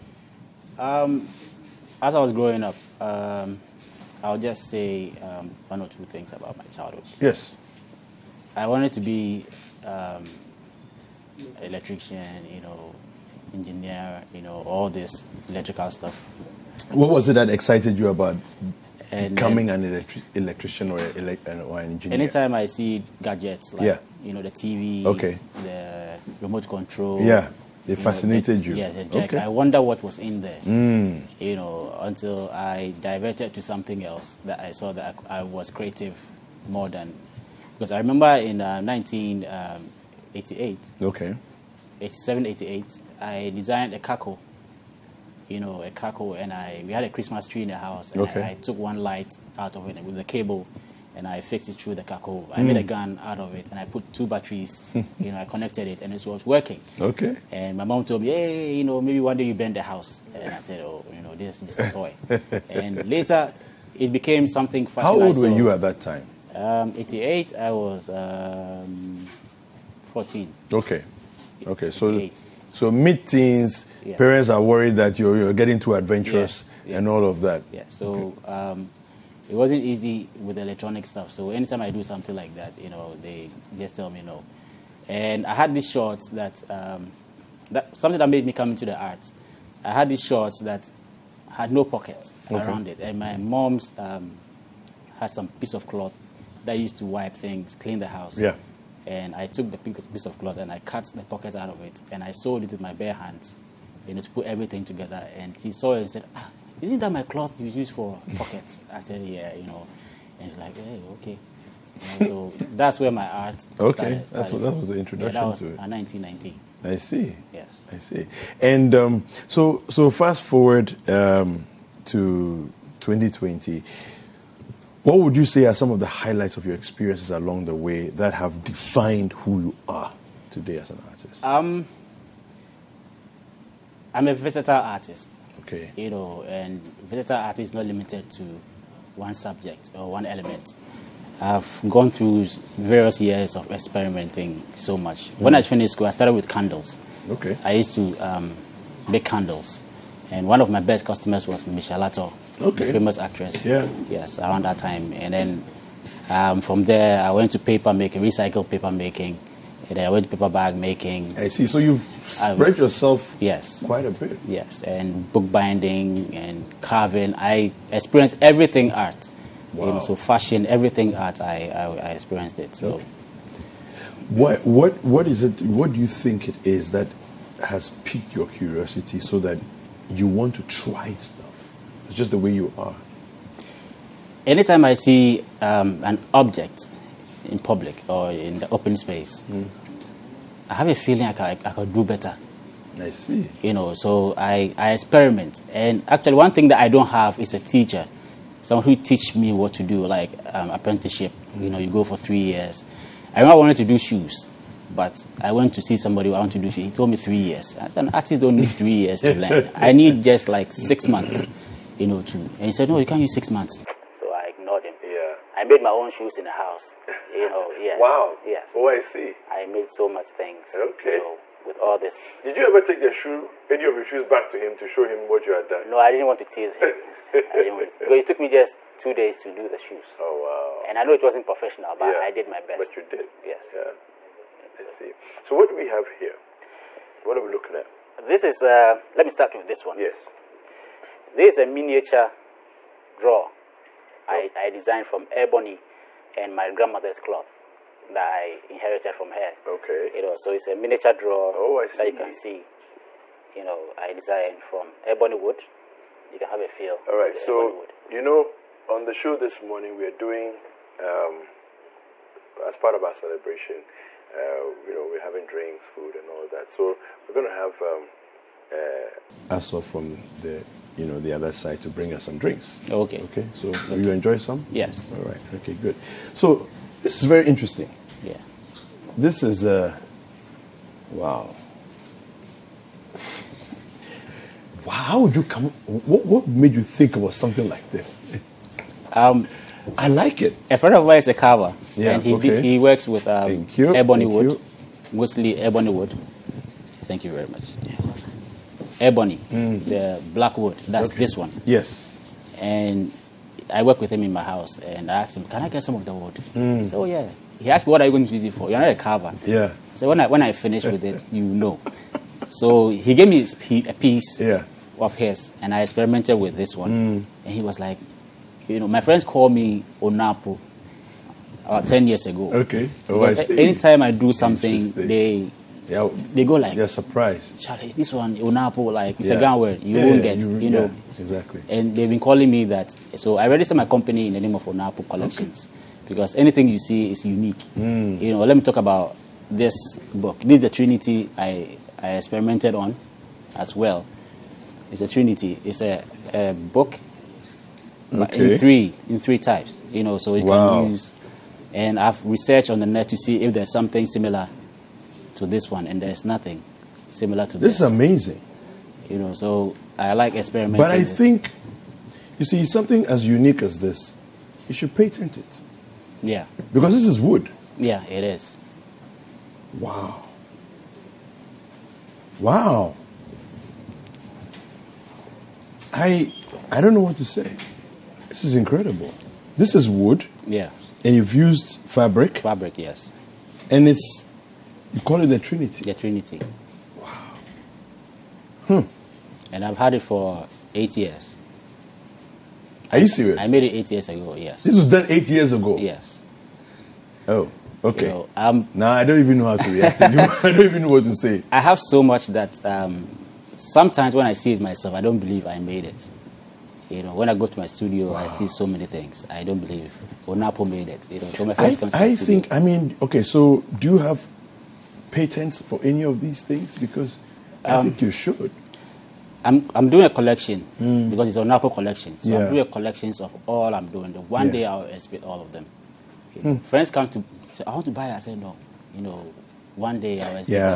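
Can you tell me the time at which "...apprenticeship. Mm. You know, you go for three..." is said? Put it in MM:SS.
03:20.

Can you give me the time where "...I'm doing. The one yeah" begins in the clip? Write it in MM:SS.
07:03.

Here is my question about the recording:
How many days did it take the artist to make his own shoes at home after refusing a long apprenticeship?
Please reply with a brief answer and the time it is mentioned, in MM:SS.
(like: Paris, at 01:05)
2, at 03:48.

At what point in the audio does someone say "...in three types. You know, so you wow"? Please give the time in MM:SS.
05:49.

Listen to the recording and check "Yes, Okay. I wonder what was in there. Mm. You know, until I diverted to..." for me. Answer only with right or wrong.
right.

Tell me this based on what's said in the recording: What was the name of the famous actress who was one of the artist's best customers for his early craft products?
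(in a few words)
Michelle.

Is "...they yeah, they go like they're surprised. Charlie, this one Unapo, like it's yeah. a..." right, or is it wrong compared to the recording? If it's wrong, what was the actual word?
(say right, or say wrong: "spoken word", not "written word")
right.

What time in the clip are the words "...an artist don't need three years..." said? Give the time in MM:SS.
03:28.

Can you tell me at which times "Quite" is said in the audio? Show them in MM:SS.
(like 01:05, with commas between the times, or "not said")
02:43.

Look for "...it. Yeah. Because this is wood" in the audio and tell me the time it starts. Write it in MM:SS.
06:05.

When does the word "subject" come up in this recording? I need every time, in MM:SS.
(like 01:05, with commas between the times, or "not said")
02:19.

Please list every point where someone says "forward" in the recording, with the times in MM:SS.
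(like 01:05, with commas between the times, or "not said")
02:00.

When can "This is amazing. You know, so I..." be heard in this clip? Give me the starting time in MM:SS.
05:57.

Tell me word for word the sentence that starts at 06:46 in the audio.
You know, when I go to my studio, wow.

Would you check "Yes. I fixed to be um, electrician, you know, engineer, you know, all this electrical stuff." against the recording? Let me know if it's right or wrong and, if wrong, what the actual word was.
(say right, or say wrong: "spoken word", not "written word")
wrong: "wanted", not "fixed".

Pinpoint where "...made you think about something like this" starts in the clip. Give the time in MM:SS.
04:46.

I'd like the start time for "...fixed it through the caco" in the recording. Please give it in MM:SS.
00:51.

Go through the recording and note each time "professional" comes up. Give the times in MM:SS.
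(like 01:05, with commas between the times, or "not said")
03:51.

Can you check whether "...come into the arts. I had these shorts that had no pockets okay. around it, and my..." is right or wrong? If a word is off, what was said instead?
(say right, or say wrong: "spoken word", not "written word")
right.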